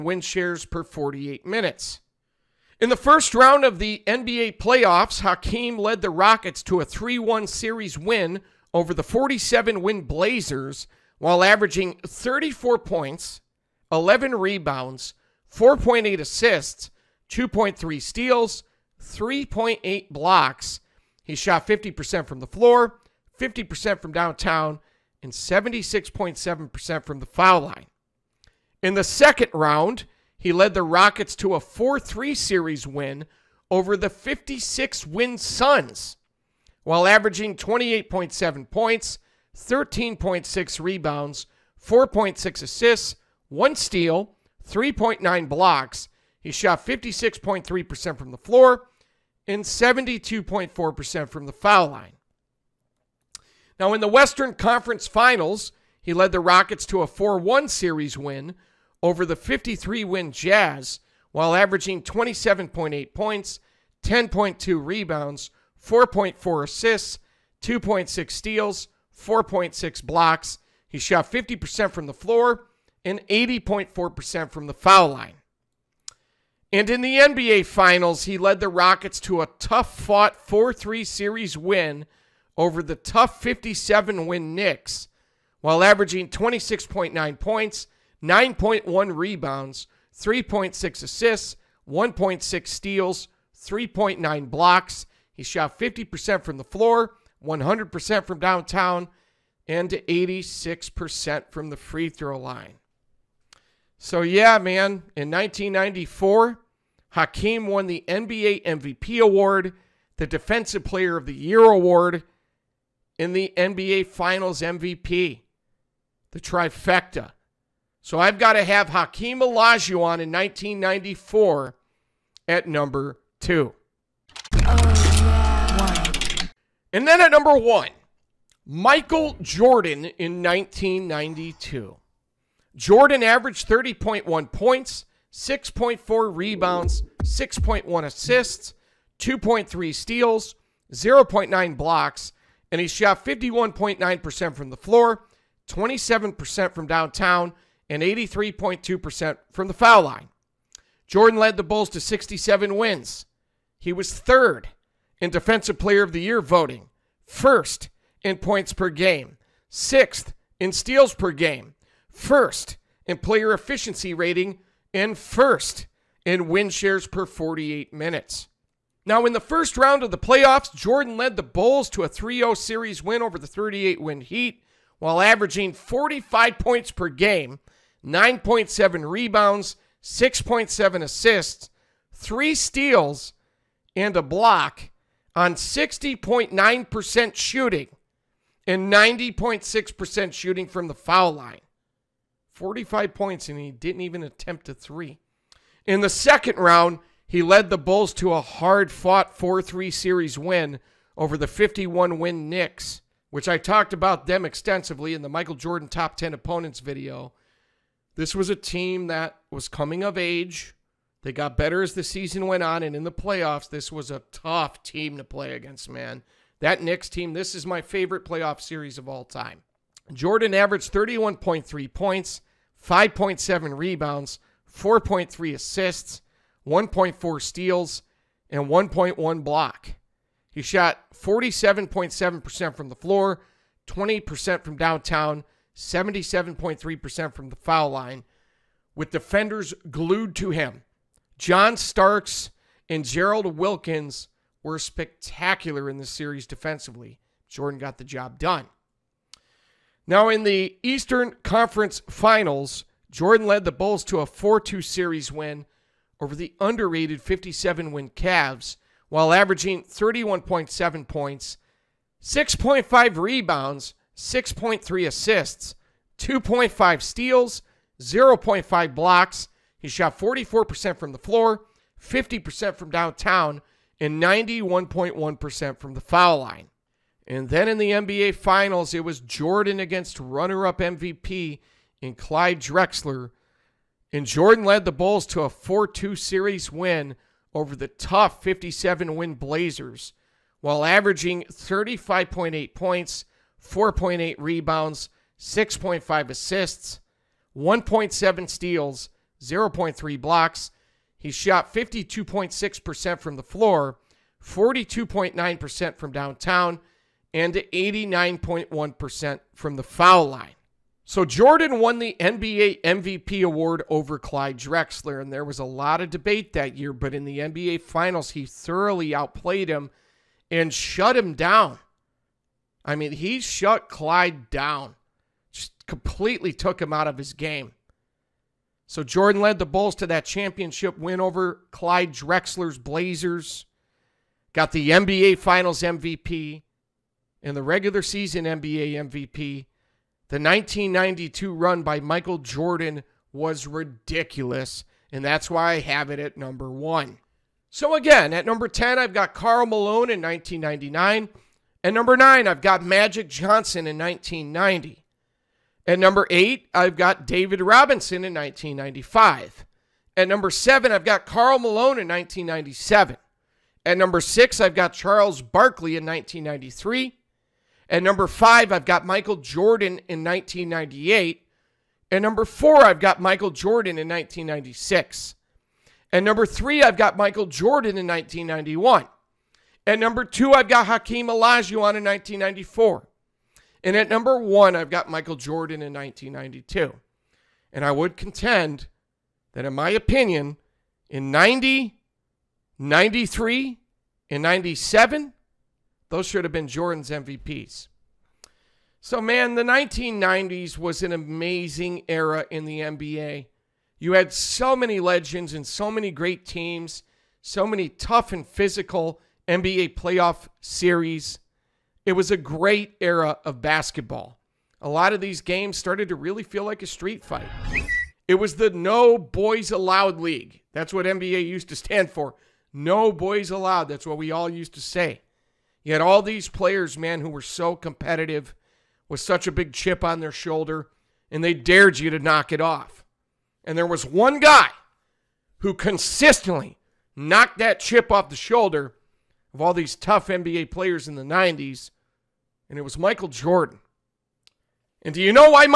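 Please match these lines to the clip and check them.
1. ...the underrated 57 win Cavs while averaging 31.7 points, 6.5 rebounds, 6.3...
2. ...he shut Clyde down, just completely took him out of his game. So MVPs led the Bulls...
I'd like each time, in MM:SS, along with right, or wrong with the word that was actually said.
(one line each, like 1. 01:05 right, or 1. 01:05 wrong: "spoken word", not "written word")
1. 04:16 right
2. 05:23 wrong: "Jordan", not "MVPs".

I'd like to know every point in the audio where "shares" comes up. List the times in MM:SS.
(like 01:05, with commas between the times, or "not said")
00:00, 02:46.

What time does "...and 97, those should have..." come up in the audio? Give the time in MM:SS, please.
06:34.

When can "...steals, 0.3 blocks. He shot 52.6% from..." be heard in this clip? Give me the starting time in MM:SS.
04:58.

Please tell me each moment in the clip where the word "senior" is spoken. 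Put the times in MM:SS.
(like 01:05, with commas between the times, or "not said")
not said.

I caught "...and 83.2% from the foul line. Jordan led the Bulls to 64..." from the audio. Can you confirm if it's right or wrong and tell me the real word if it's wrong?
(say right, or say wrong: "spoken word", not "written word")
wrong: "67", not "64".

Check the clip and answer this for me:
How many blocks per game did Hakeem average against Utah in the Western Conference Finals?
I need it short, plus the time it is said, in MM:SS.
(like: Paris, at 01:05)
4.6, at 01:09.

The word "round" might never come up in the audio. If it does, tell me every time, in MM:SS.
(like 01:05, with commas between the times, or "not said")
00:03, 00:29, 02:49, 03:16.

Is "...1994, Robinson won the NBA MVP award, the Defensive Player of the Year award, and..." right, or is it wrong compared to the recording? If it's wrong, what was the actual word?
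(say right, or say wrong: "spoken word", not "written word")
wrong: "Hakeem", not "Robinson".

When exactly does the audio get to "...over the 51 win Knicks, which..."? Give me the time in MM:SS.
03:21.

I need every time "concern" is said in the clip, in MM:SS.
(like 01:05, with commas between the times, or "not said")
not said.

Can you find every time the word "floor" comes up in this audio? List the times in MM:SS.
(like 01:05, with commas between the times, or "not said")
00:22, 00:48, 01:12, 01:36, 02:24, 03:52, 04:31, 05:03.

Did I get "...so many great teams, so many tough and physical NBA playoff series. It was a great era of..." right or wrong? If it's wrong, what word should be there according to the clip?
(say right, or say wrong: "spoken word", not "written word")
right.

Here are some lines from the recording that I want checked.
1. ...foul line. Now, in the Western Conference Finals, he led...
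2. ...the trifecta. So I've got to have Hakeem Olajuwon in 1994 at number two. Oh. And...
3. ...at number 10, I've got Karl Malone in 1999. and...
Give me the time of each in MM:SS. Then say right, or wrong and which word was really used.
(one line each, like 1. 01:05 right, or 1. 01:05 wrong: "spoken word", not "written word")
1. 00:51 right
2. 01:56 right
3. 05:48 right.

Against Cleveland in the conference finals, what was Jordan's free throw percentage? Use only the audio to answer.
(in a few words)
91.1%.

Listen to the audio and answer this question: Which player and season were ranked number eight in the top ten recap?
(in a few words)
David Robinson in 1995.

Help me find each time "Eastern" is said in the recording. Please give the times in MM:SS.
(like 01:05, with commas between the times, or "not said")
04:10.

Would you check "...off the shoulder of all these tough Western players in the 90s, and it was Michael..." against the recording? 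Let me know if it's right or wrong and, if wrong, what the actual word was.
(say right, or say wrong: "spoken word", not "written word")
wrong: "NBA", not "Western".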